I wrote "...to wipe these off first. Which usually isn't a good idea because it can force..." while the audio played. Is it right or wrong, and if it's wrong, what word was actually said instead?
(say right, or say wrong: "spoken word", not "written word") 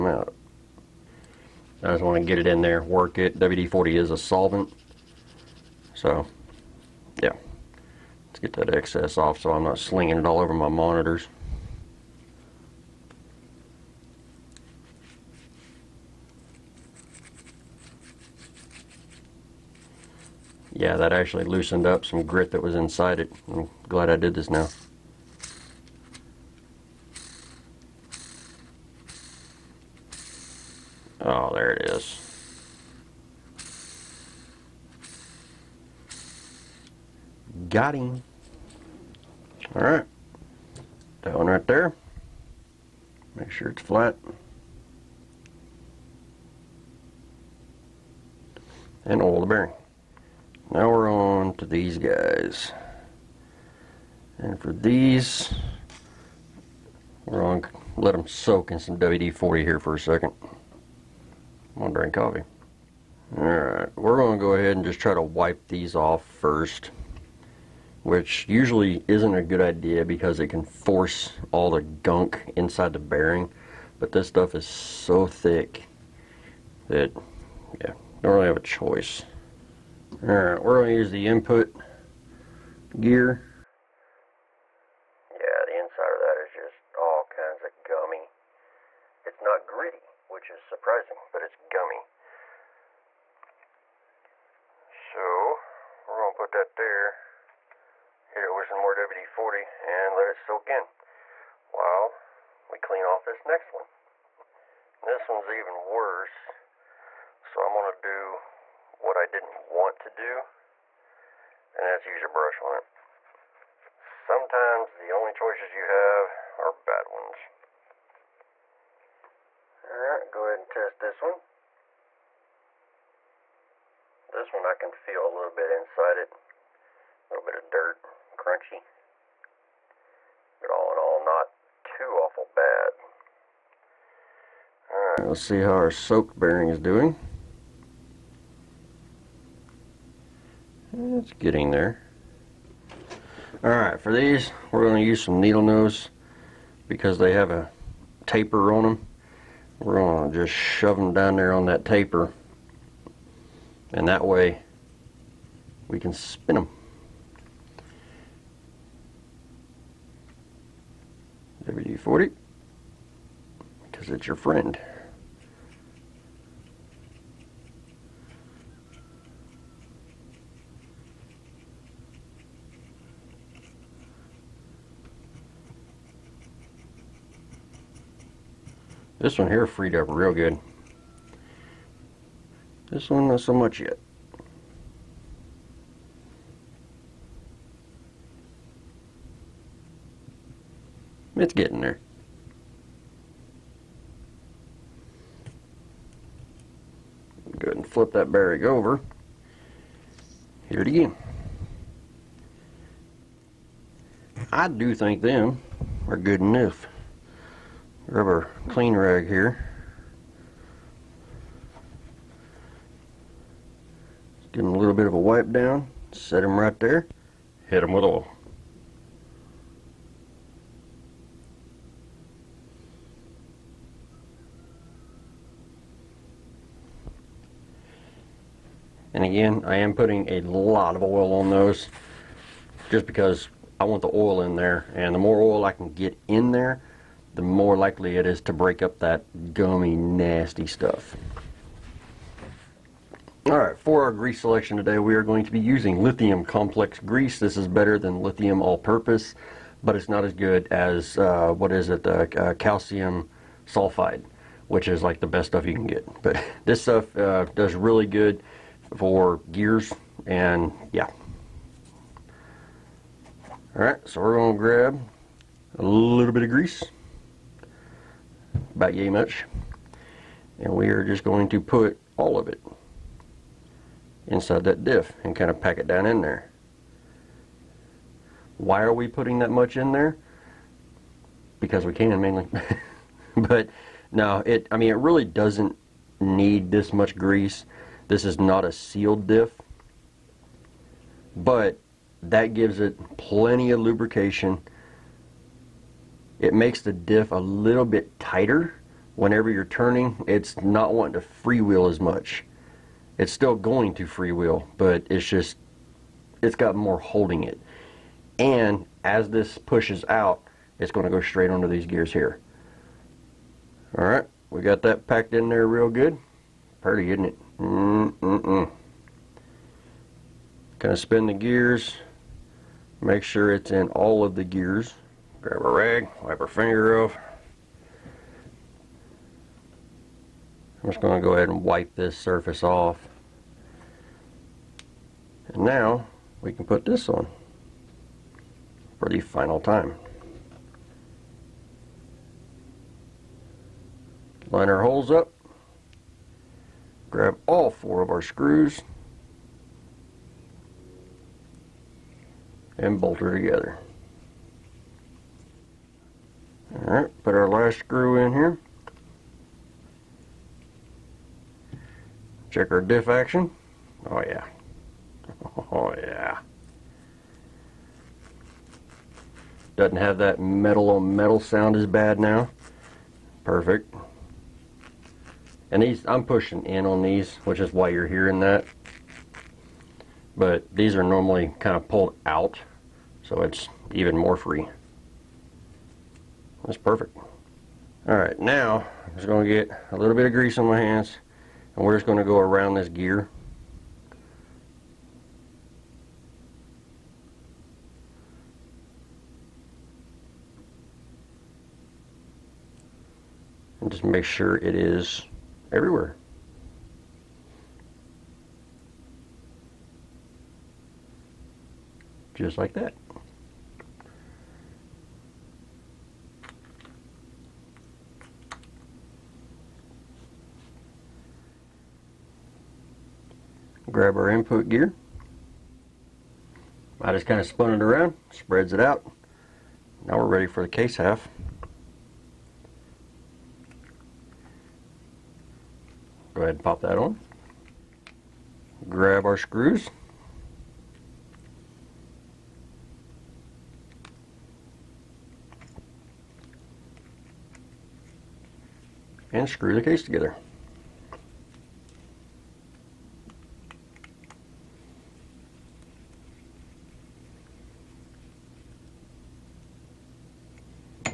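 right.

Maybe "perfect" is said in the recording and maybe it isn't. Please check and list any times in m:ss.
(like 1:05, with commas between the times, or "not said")
6:13, 6:26.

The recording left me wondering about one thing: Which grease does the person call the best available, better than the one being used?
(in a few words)
Calcium sulfide.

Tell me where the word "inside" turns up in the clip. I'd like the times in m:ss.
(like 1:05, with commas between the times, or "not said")
0:22, 1:12, 1:25, 2:05, 4:34.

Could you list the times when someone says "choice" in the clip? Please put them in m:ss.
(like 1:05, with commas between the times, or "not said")
1:18, 1:55.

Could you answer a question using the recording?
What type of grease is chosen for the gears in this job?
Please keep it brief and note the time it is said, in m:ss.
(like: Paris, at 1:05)
Lithium complex grease, at 4:06.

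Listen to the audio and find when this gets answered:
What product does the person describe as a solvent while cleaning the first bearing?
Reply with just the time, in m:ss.
0:03.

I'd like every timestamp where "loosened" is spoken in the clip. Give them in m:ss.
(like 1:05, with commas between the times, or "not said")
0:21.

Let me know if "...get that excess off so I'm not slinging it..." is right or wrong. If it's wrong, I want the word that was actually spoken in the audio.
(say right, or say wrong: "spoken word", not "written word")
right.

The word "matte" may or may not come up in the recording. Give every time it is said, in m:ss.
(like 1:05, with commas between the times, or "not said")
not said.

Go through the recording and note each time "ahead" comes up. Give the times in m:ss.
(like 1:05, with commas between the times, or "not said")
1:04, 2:00, 3:17, 5:31, 7:16.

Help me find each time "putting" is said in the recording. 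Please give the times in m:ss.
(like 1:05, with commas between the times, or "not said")
3:49, 4:39.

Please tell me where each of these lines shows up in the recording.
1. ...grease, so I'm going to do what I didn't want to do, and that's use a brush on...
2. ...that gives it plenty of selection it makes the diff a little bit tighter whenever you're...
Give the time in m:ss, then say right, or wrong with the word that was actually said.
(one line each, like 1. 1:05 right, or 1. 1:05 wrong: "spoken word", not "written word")
1. 1:45 wrong: "worse", not "grease"
2. 4:52 wrong: "lubrication", not "selection".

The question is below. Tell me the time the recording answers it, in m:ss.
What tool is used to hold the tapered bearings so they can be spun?
2:25.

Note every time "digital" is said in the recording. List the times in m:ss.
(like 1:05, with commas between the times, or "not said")
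not said.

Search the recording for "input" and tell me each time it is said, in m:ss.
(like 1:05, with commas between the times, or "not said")
1:21, 7:04.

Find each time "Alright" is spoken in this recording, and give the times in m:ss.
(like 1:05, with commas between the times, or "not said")
1:03, 1:20, 1:59, 2:14, 2:23, 4:03, 4:23, 5:56.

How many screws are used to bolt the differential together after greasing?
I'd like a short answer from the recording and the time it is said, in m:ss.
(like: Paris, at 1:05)
4, at 5:47.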